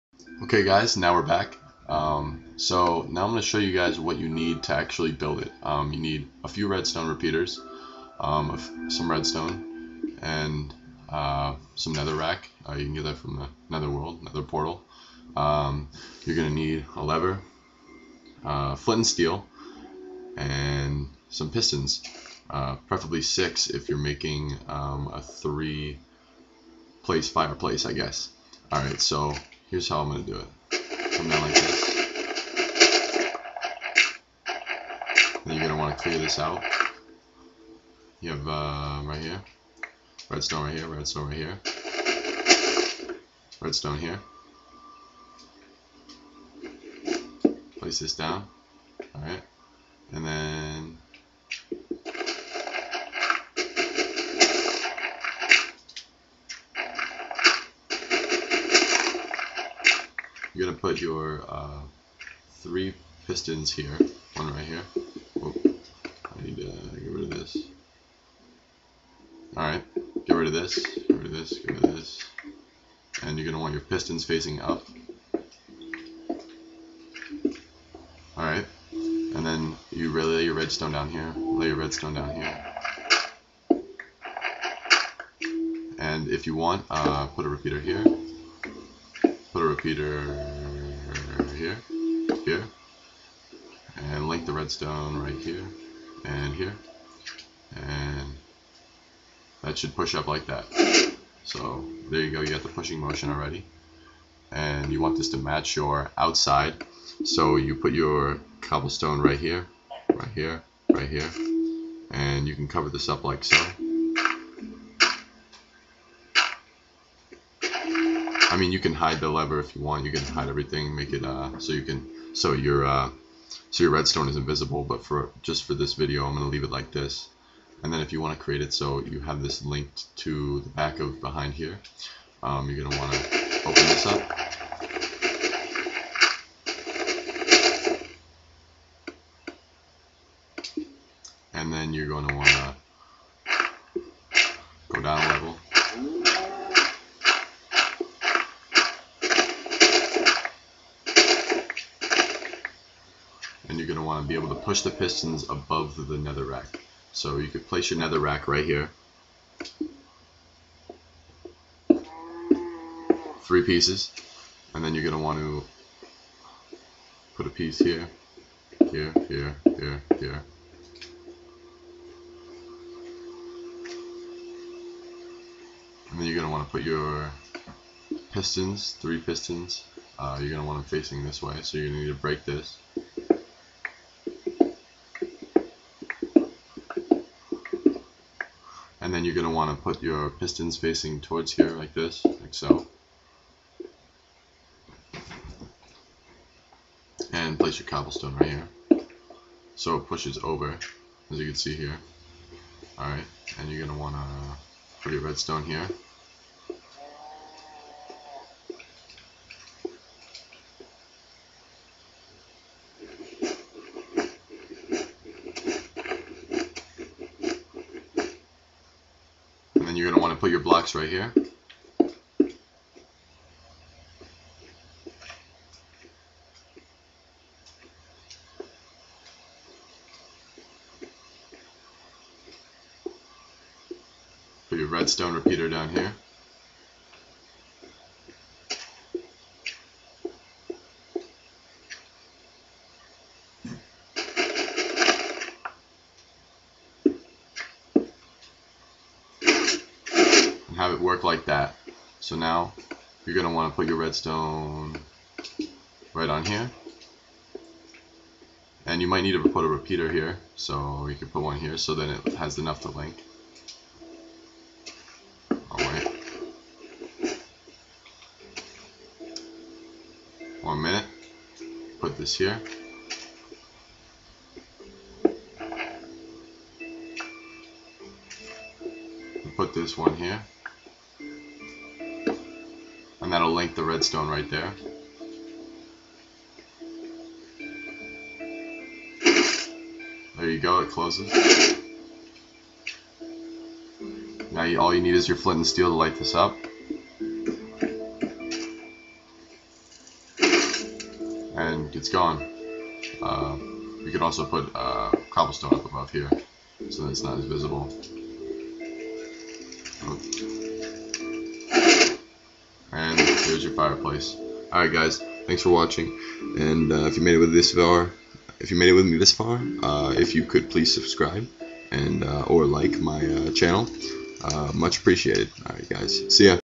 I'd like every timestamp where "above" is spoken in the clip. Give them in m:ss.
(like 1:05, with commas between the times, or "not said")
2:35, 5:05.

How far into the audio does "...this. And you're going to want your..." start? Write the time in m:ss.
1:11.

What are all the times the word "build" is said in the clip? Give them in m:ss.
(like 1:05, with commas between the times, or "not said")
0:05.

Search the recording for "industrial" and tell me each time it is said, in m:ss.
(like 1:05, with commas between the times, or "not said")
not said.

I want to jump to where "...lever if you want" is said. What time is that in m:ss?
1:59.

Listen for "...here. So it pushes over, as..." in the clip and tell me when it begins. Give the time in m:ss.
3:18.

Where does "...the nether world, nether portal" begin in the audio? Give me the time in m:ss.
0:13.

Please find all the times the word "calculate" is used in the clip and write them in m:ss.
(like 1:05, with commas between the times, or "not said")
not said.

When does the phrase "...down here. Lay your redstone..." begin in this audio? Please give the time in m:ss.
1:20.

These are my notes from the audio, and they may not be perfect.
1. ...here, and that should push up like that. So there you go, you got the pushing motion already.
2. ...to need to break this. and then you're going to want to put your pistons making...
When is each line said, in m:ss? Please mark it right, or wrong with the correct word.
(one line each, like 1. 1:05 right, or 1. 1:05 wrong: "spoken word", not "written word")
1. 1:36 right
2. 3:02 wrong: "facing", not "making".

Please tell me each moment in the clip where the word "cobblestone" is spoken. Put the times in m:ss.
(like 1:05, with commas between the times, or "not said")
1:48, 3:17, 5:05.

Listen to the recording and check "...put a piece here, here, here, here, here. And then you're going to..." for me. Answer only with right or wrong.
right.